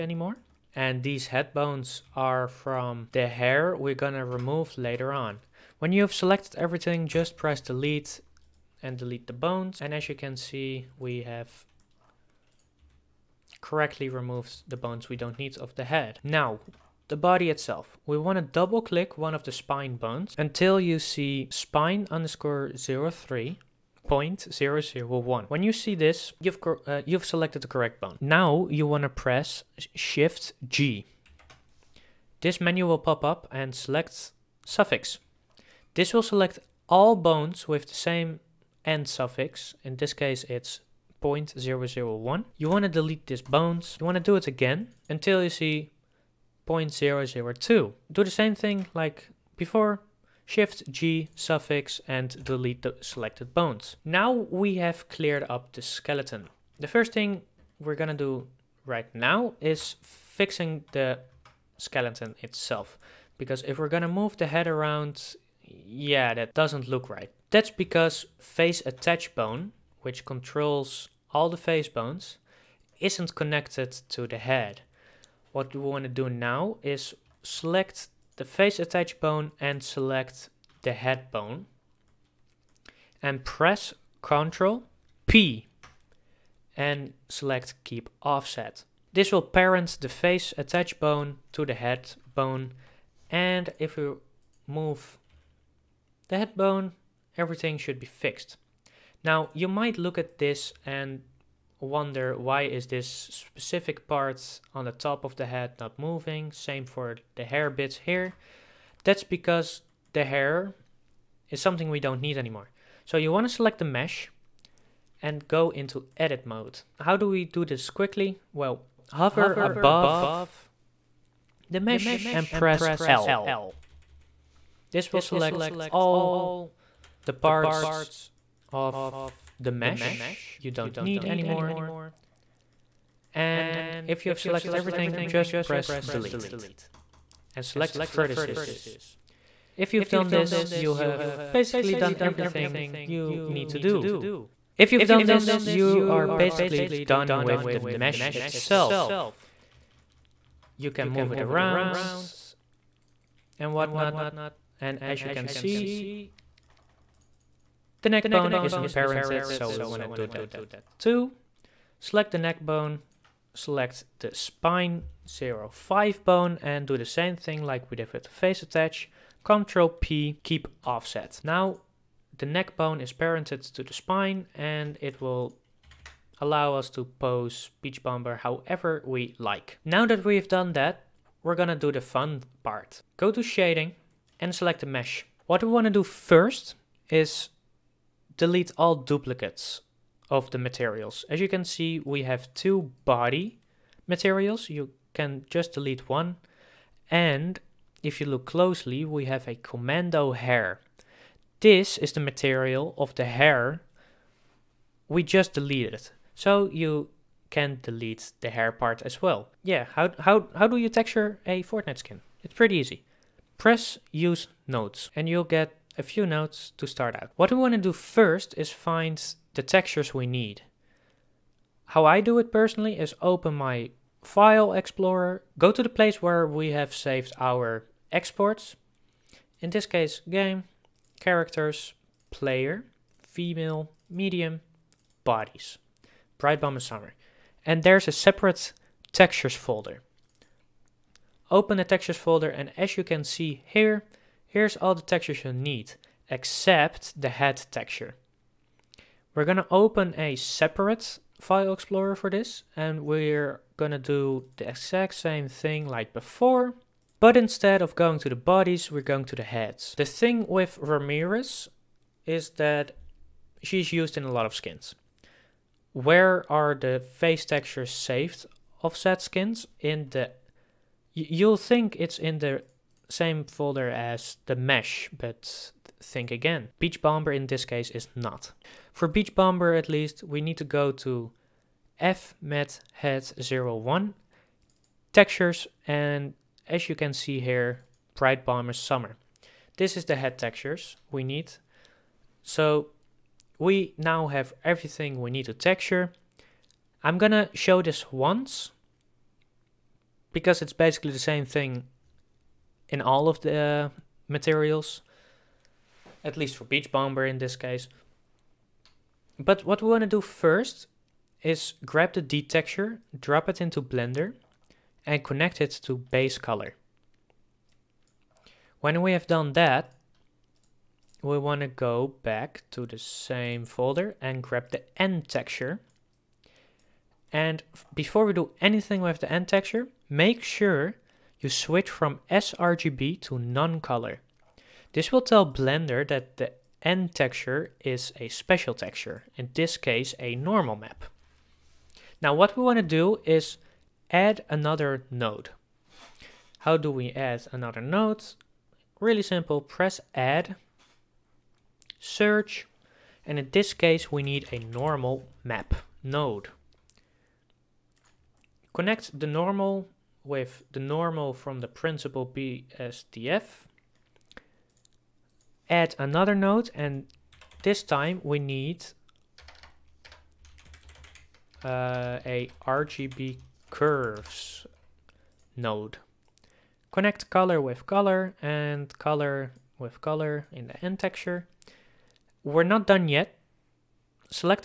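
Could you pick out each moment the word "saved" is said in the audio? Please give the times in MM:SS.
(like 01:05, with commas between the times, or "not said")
03:46, 04:27.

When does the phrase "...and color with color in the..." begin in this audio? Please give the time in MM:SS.
06:18.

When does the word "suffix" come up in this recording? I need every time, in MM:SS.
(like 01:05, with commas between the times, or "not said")
00:34, 00:39, 00:51.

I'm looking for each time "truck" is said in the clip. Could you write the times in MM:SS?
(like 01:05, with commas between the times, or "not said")
not said.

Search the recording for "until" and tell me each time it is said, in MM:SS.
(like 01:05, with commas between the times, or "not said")
00:20, 00:45.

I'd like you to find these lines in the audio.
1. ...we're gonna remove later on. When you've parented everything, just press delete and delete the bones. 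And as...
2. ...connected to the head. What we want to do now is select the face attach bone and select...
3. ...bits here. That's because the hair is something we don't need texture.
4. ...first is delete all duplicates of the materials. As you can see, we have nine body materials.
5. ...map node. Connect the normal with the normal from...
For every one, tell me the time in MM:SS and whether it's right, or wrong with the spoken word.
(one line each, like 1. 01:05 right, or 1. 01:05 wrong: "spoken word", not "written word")
1. 00:03 wrong: "selected", not "parented"
2. 01:13 right
3. 01:47 wrong: "anymore", not "texture"
4. 03:06 wrong: "two", not "nine"
5. 05:55 right.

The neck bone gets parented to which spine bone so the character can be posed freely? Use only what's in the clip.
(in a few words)
Spine 05.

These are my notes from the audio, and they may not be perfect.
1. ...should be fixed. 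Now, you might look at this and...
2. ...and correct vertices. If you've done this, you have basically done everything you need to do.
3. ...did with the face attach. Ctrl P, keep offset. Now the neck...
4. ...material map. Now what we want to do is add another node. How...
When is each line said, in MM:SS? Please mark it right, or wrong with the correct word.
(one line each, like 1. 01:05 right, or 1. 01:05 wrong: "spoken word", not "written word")
1. 01:37 right
2. 02:17 wrong: "select", not "correct"
3. 02:47 right
4. 05:40 wrong: "normal", not "material".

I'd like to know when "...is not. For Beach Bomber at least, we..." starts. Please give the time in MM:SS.
04:37.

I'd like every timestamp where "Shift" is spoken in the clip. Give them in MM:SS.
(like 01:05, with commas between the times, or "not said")
00:29, 00:50.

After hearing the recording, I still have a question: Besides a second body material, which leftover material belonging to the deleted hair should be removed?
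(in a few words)
Commando hair.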